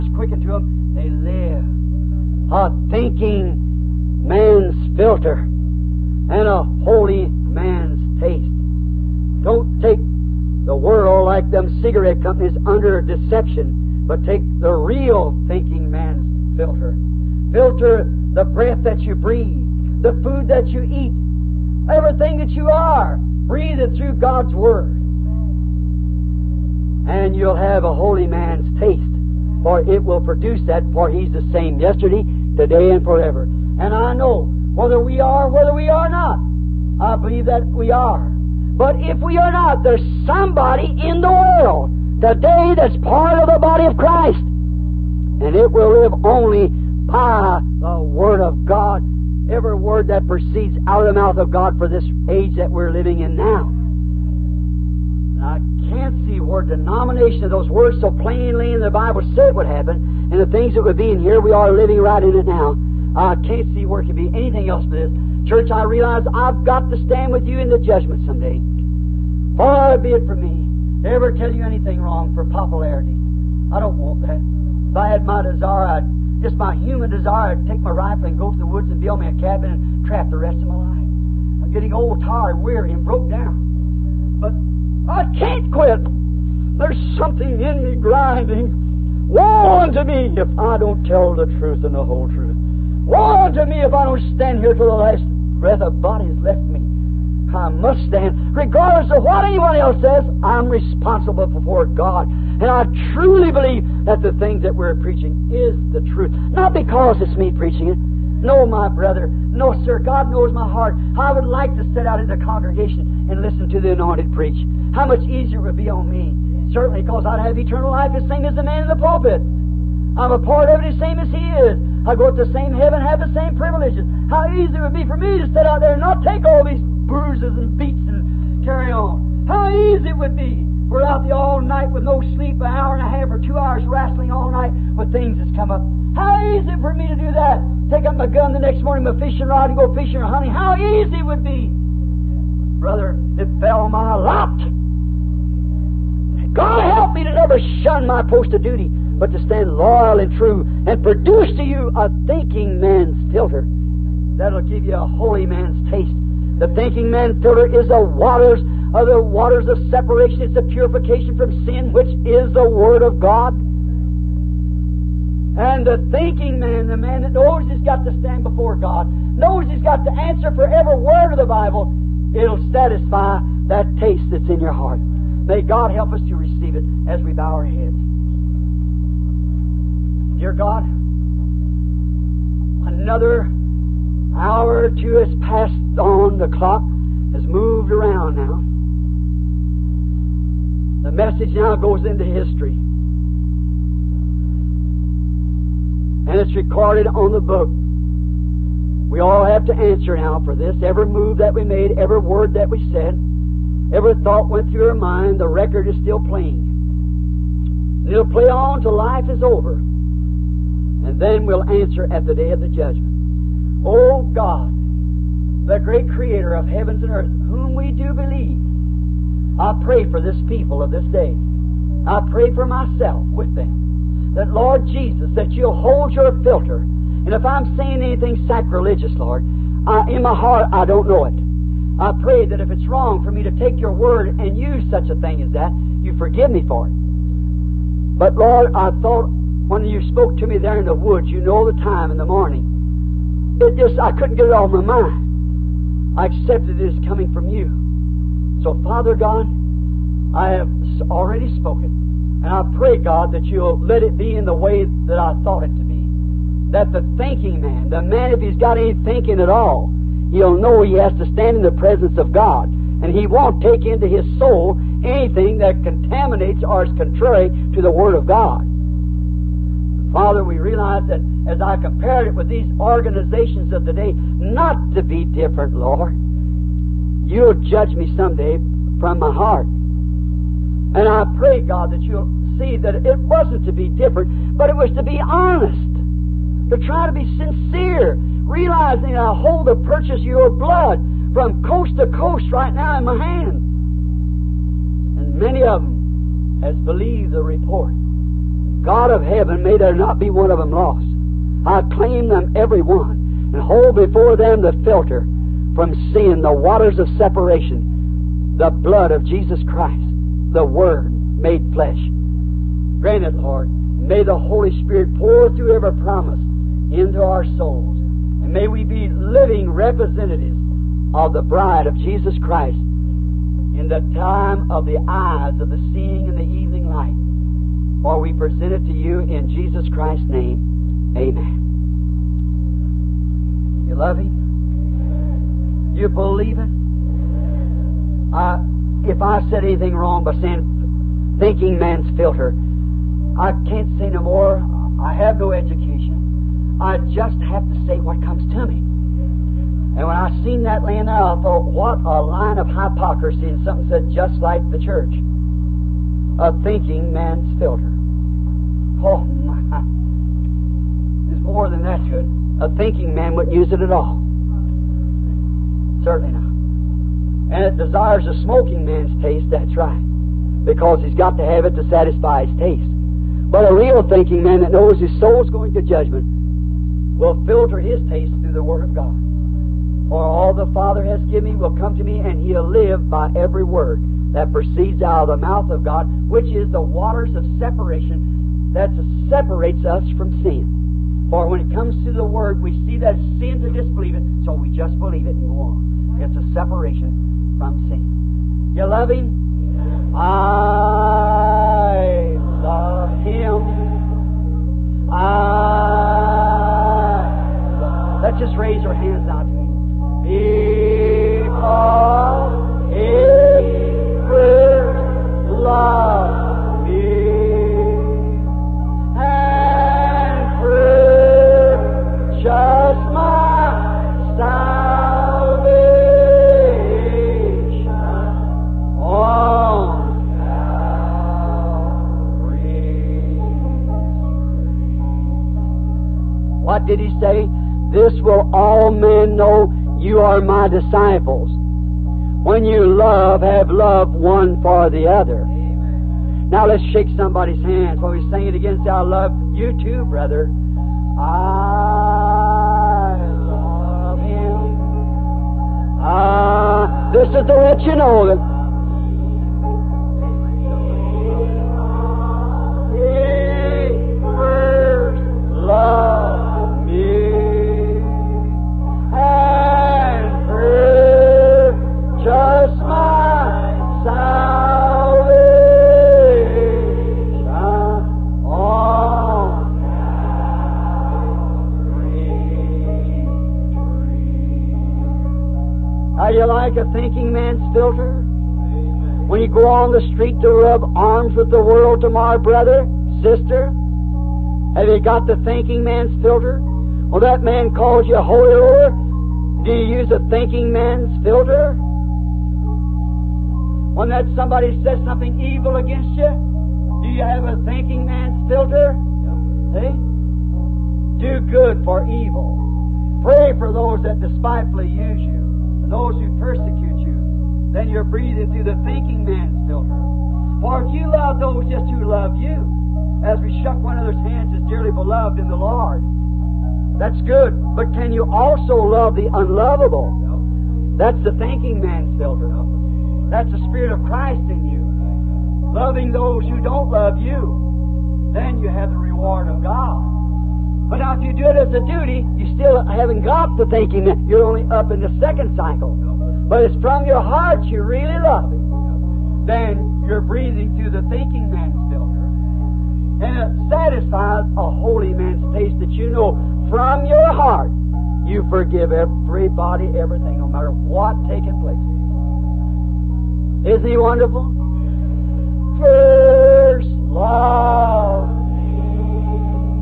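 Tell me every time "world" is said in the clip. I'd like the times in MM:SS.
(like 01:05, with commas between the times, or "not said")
00:10, 00:41, 08:11.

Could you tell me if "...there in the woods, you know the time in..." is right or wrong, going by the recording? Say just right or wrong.
right.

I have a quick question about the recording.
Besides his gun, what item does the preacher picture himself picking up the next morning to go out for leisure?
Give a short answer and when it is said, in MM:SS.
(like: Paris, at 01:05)
fishing rod, at 02:19.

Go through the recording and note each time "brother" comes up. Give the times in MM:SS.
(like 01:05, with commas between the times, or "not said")
01:48, 02:22, 07:30, 08:12.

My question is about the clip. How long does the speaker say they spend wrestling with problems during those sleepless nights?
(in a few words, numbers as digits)
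an hour and a half or two hours.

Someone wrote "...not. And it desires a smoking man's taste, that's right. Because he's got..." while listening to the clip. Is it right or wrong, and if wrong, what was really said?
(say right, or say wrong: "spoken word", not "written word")
right.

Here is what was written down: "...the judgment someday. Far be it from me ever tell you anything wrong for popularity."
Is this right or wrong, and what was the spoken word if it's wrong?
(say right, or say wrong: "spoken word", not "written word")
right.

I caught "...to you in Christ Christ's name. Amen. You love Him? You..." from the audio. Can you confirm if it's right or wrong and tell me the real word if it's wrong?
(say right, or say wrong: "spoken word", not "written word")
wrong: "Jesus", not "Christ".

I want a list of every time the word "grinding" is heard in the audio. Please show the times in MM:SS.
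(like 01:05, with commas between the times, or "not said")
01:27.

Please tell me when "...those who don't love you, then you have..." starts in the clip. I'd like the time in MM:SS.
08:56.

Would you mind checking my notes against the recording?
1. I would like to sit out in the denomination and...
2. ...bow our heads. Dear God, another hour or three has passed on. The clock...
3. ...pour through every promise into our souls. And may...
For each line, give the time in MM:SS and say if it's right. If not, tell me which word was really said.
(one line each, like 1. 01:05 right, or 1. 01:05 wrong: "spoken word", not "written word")
1. 01:51 wrong: "congregation", not "denomination"
2. 02:57 wrong: "two", not "three"
3. 05:15 right.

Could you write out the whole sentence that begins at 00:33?
And I know whether we are, whether we are not, I believe that we are.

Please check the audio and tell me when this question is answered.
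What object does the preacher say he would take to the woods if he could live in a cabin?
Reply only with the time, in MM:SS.
01:17.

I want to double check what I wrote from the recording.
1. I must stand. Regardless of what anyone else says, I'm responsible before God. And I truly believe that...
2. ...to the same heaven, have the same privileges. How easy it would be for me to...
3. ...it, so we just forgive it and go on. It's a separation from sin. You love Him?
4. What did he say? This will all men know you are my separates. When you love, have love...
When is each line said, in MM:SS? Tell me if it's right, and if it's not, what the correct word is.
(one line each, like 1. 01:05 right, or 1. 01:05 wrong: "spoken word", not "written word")
1. 01:37 right
2. 02:02 right
3. 06:34 wrong: "believe", not "forgive"
4. 07:16 wrong: "disciples", not "separates".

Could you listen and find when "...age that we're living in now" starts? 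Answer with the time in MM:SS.
00:52.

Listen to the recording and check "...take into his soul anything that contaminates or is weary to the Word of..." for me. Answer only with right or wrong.
wrong.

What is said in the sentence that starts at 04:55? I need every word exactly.
And many of them has believed the report.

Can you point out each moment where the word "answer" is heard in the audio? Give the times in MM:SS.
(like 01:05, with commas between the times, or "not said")
02:50, 03:19, 03:31.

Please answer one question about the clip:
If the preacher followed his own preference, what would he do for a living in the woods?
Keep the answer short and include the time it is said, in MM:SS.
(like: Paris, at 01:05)
trap, at 01:20.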